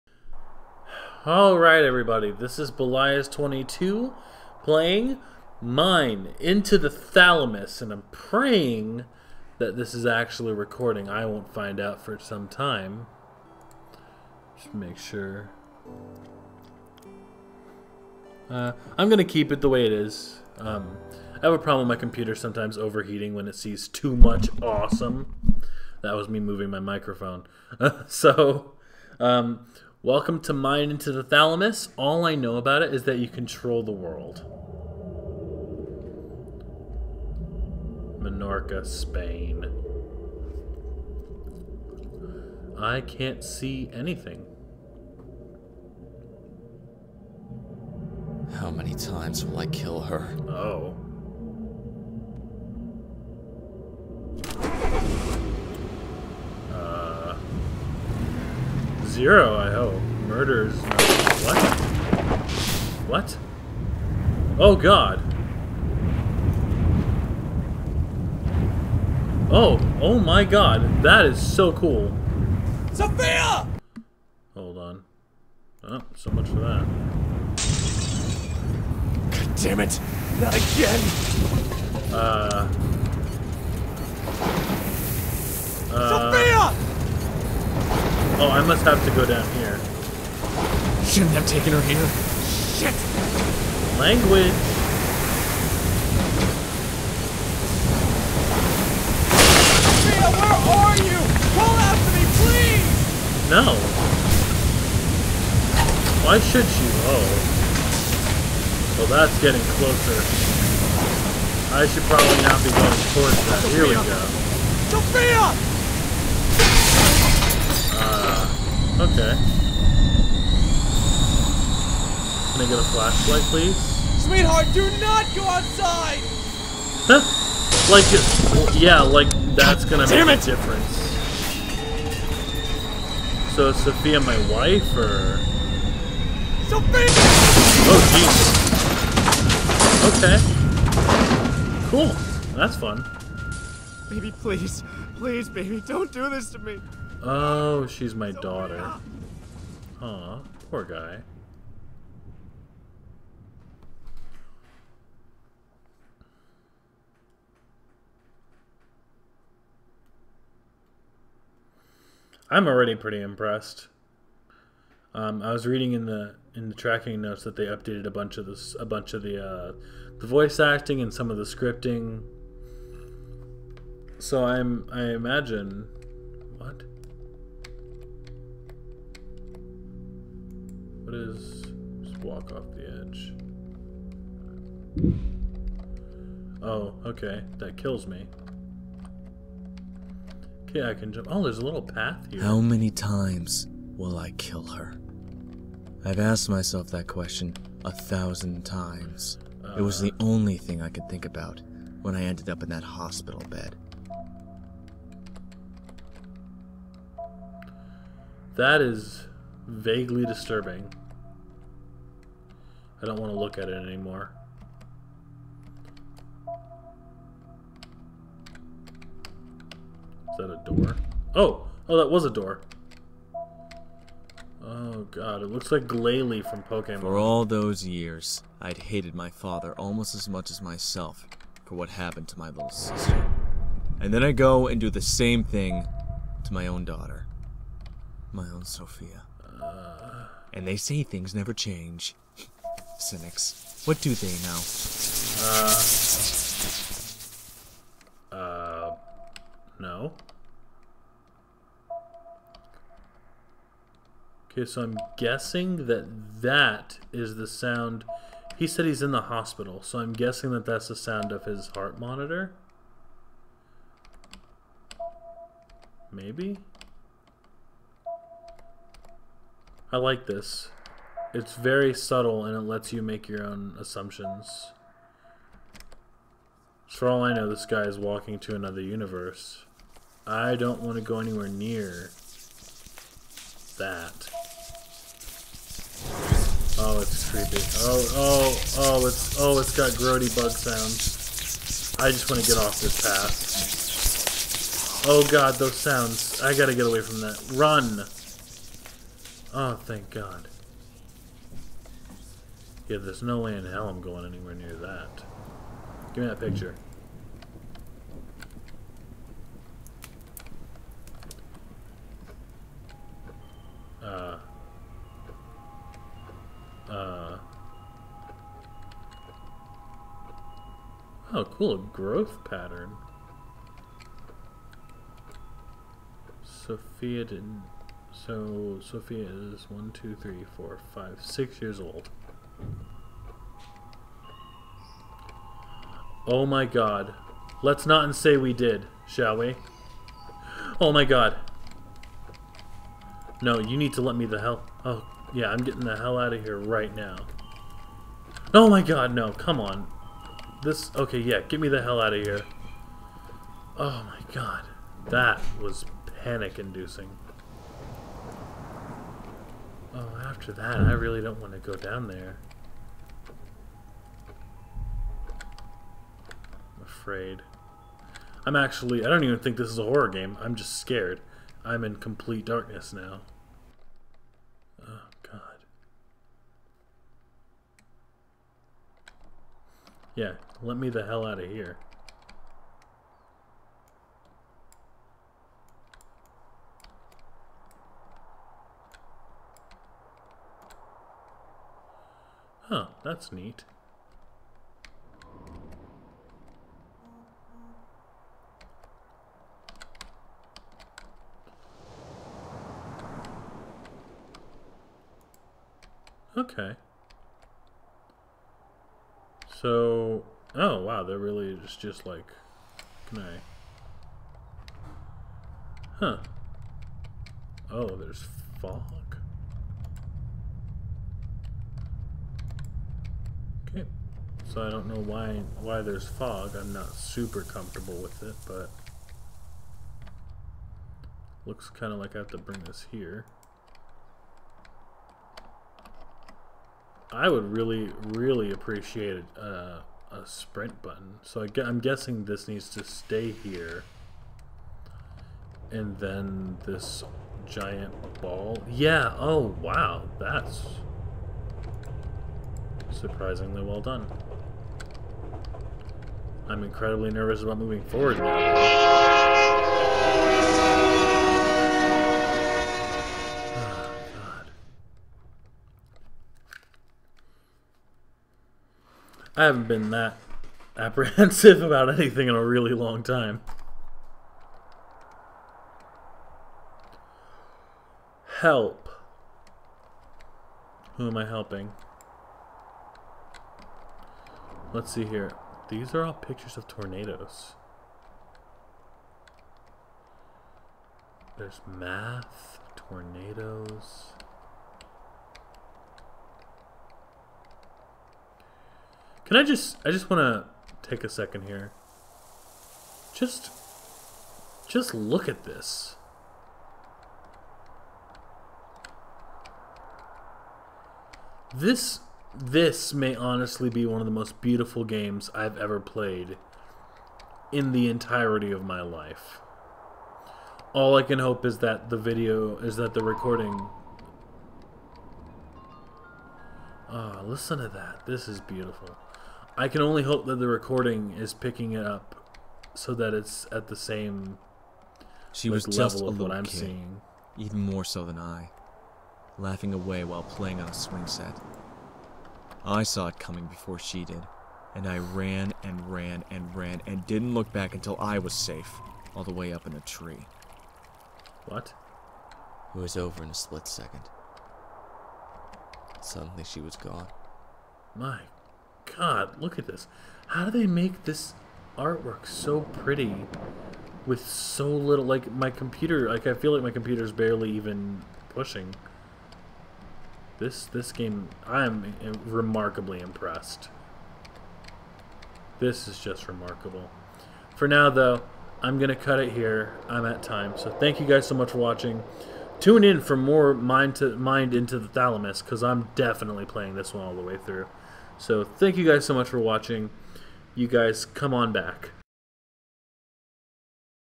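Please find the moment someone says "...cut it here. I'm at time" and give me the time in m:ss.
9:38.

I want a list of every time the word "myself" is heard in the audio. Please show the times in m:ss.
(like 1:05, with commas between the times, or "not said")
3:16, 3:50.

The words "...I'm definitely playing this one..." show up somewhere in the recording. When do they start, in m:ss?
9:45.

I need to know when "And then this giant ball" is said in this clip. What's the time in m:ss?
7:25.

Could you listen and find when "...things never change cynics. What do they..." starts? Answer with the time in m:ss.
4:01.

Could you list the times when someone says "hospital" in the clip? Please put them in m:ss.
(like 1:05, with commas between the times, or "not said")
3:22, 4:19.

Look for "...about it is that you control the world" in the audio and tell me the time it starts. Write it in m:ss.
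0:32.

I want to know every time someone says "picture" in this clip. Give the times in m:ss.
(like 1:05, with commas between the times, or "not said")
5:06, 8:06.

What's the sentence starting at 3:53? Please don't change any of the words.
And then I go and do the same thing to my own daughter.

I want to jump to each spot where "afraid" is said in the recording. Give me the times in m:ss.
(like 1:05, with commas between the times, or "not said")
6:06.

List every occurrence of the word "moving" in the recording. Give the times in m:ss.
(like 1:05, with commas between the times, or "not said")
0:26, 7:37.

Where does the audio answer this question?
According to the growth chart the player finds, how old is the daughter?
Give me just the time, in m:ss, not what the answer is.
5:31.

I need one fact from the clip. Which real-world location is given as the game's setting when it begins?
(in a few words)
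Menorca, Spain.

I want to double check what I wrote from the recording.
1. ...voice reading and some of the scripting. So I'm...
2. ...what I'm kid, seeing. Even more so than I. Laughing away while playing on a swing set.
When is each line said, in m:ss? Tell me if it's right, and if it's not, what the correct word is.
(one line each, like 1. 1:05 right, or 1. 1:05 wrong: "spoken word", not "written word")
1. 2:50 wrong: "acting", not "reading"
2. 8:56 right.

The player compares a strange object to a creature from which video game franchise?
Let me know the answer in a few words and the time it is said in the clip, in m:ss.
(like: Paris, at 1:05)
Pokemon, at 3:46.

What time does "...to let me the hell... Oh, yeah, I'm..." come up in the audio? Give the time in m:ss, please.
5:43.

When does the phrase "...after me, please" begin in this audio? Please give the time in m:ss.
1:41.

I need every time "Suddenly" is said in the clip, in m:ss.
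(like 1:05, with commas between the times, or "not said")
9:15.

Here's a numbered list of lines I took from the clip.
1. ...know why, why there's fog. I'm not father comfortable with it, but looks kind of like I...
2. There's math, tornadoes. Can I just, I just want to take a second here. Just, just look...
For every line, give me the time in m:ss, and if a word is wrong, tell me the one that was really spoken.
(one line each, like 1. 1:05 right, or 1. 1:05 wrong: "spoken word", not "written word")
1. 7:04 wrong: "super", not "father"
2. 8:11 right.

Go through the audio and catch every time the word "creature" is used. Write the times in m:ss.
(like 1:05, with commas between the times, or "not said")
not said.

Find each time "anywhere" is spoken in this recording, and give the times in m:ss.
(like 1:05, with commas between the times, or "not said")
4:41, 5:04.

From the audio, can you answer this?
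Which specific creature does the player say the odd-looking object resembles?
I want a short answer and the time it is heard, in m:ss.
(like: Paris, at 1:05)
Glalie, at 3:45.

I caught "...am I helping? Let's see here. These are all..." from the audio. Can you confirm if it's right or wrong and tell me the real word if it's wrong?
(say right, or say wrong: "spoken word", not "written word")
right.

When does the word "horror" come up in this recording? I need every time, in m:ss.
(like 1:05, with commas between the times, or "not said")
6:09.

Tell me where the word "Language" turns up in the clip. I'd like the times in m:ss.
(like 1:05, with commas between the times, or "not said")
1:34.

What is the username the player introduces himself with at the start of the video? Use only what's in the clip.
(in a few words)
Belias22.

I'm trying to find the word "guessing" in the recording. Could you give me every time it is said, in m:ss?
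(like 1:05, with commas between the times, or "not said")
4:15, 4:20, 7:21.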